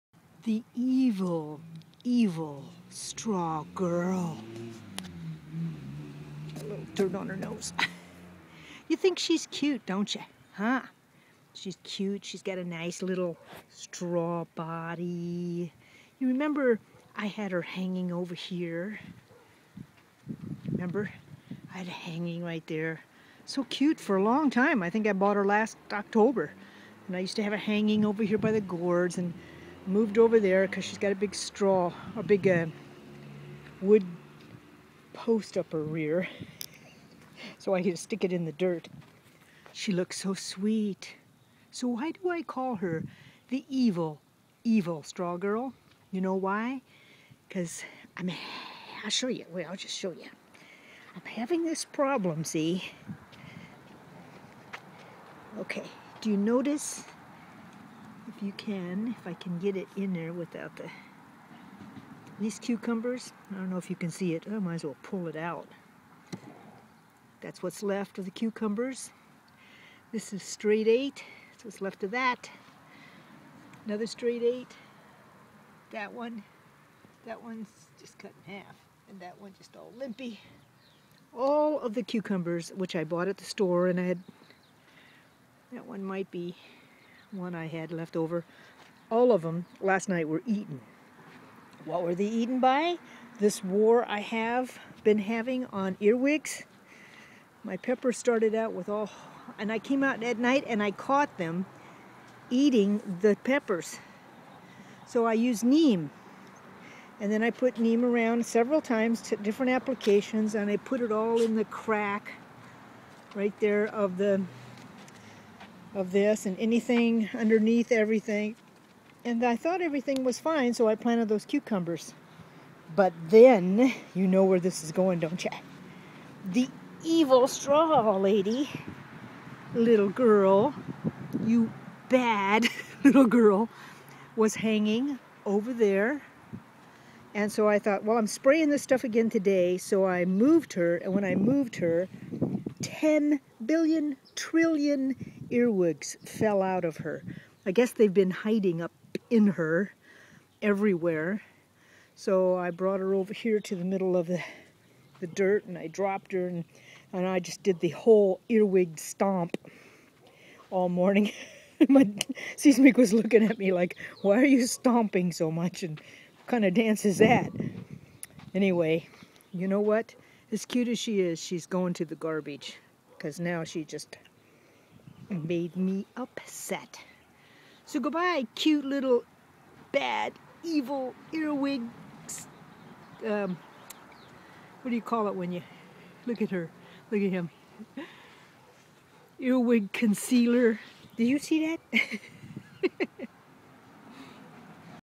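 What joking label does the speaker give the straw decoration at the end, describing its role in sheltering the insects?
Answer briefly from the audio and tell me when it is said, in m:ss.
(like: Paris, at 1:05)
earwig concealer, at 3:09.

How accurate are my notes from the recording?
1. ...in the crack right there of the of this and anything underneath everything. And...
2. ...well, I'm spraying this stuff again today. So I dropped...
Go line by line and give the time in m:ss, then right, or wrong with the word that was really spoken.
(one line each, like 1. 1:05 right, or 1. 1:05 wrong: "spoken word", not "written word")
1. 1:51 right
2. 2:18 wrong: "moved", not "dropped".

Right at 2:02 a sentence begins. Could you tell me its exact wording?
But then, you know where this is going, don't you?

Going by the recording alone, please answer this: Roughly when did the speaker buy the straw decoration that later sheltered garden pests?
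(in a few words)
last October.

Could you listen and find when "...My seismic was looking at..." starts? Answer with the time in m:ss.
2:41.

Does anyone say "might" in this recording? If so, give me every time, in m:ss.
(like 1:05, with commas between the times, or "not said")
1:04, 1:26.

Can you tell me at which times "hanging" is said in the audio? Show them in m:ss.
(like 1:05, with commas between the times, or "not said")
0:17, 0:21, 0:27, 2:14.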